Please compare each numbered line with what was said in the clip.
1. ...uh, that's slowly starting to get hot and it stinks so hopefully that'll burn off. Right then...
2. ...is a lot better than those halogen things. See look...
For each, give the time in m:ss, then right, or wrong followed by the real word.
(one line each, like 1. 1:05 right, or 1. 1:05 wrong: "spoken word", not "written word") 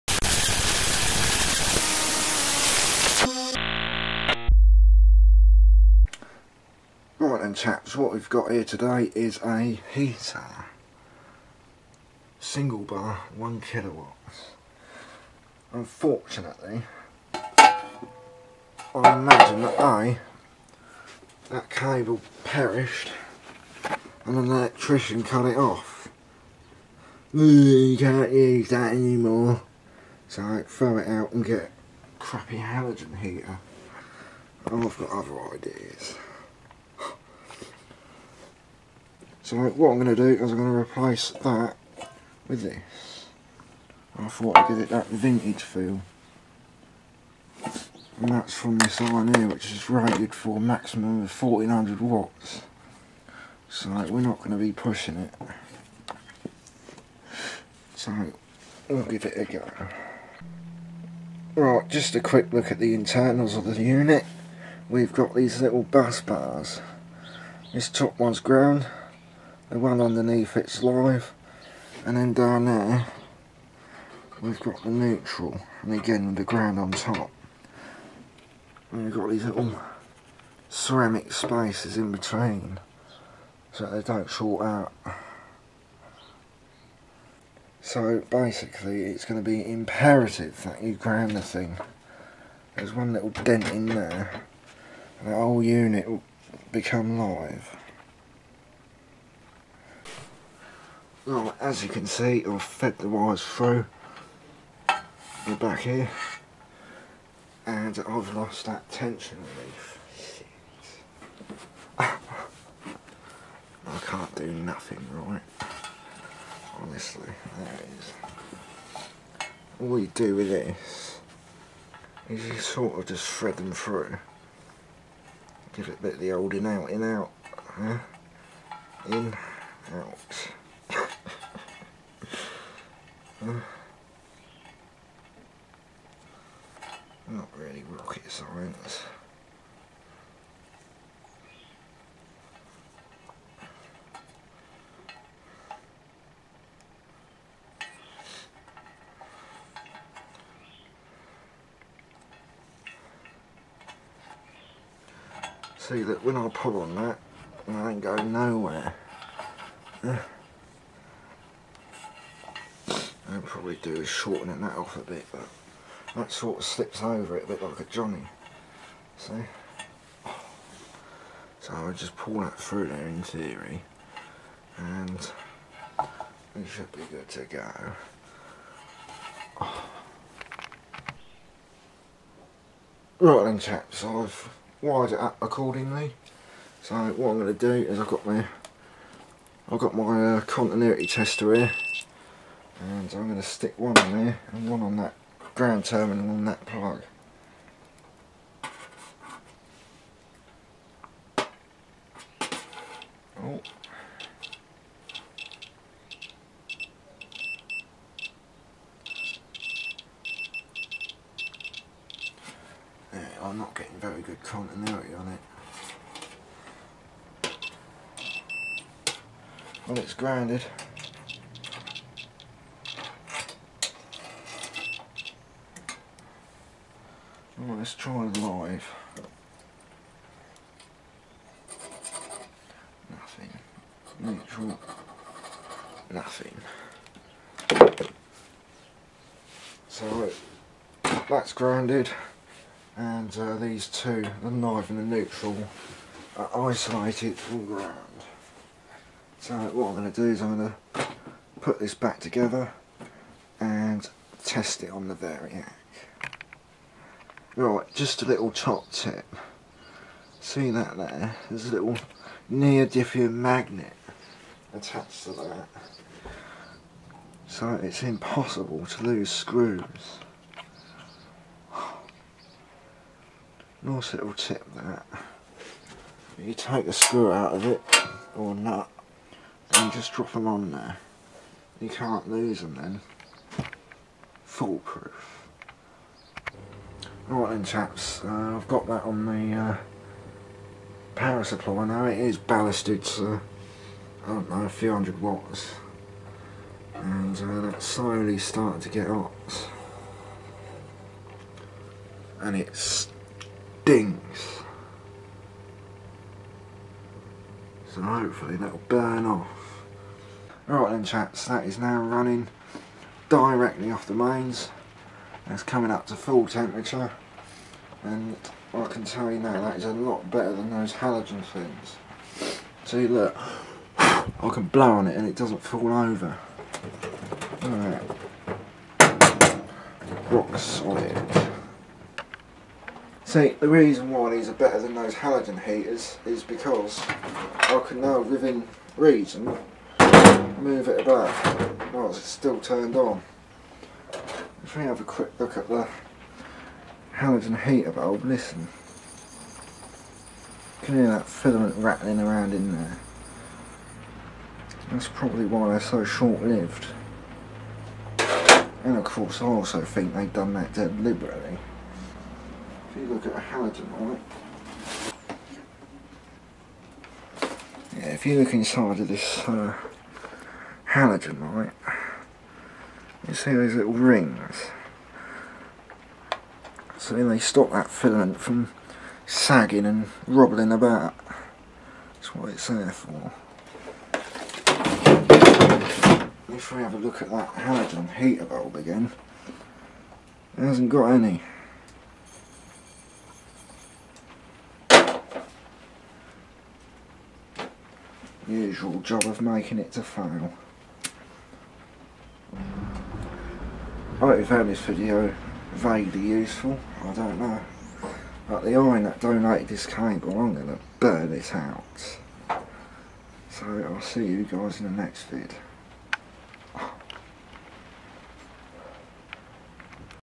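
1. 4:57 right
2. 5:19 right.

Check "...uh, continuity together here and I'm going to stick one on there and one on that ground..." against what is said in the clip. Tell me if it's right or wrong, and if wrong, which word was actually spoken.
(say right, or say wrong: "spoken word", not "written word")
wrong: "tester", not "together".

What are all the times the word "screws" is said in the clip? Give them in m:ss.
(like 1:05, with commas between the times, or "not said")
4:29, 4:36.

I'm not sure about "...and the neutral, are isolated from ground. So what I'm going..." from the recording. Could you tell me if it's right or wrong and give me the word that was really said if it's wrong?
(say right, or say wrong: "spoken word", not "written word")
right.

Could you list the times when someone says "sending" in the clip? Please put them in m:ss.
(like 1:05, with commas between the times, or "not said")
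not said.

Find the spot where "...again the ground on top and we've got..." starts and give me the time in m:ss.
1:15.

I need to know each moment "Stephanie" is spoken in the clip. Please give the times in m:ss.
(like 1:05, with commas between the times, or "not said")
not said.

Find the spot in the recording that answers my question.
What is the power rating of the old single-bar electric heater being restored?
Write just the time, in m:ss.
0:13.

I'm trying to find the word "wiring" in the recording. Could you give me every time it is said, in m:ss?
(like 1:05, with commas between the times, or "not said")
not said.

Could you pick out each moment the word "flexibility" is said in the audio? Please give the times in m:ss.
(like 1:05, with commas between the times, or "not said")
not said.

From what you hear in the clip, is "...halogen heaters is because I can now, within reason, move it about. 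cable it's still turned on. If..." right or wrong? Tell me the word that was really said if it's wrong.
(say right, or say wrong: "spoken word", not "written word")
wrong: "while", not "cable".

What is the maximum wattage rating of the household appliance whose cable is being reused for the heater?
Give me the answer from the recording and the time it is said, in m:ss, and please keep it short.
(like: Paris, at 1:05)
1400 watts, at 0:51.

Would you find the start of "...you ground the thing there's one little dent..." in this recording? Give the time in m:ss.
1:30.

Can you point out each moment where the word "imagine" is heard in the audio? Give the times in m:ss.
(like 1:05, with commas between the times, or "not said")
0:18.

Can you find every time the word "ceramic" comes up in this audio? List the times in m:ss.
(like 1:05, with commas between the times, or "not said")
1:20.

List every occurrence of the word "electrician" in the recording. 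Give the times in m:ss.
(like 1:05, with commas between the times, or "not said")
0:24.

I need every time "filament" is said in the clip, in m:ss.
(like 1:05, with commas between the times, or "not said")
5:51, 6:17.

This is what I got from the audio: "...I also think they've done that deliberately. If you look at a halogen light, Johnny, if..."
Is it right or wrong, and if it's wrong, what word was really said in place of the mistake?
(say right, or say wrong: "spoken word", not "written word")
wrong: "Yeah", not "Johnny".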